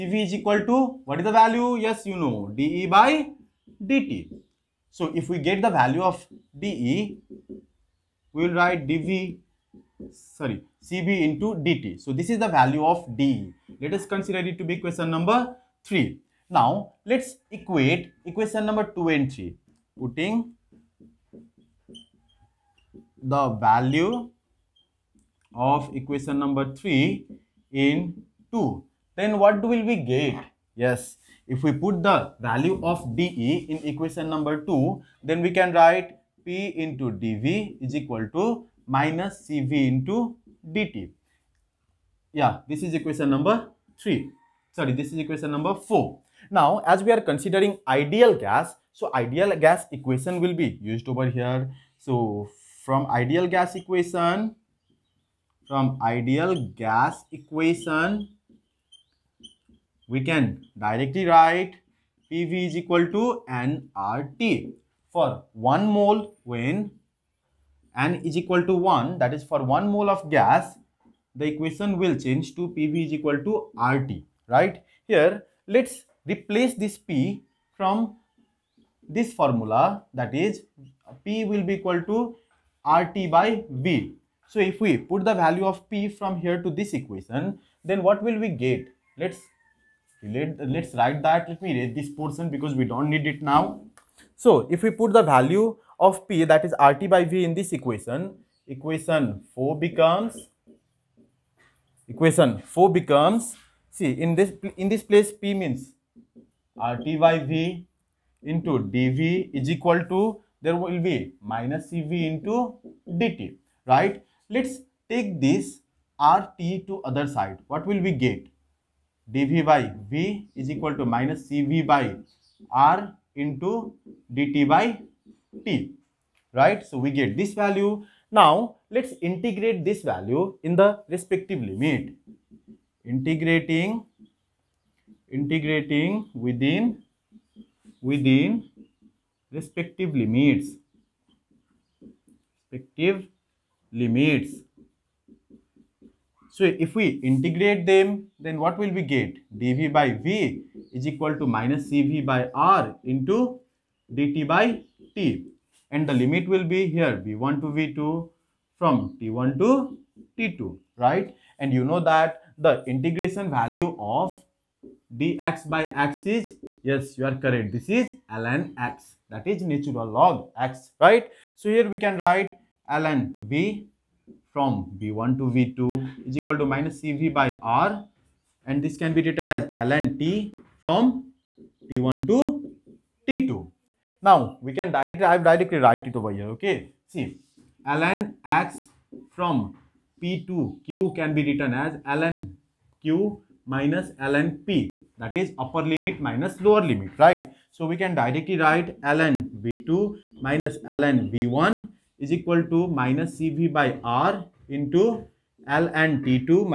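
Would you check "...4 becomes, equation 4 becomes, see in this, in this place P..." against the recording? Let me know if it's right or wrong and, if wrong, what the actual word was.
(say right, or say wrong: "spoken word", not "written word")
right.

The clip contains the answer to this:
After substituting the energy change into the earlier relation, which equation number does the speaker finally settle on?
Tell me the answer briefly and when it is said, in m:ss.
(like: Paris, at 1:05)
4, at 0:45.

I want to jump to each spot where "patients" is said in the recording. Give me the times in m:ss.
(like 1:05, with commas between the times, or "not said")
not said.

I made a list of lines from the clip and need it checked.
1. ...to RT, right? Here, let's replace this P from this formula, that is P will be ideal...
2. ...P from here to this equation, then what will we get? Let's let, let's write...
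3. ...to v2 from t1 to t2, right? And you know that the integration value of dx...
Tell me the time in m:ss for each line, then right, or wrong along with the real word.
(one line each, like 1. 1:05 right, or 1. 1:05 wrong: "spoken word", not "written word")
1. 1:13 wrong: "equal", not "ideal"
2. 1:25 right
3. 2:37 right.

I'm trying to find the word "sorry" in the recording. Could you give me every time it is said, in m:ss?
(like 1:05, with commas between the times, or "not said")
0:10, 0:44.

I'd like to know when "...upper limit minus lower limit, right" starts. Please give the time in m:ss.
3:15.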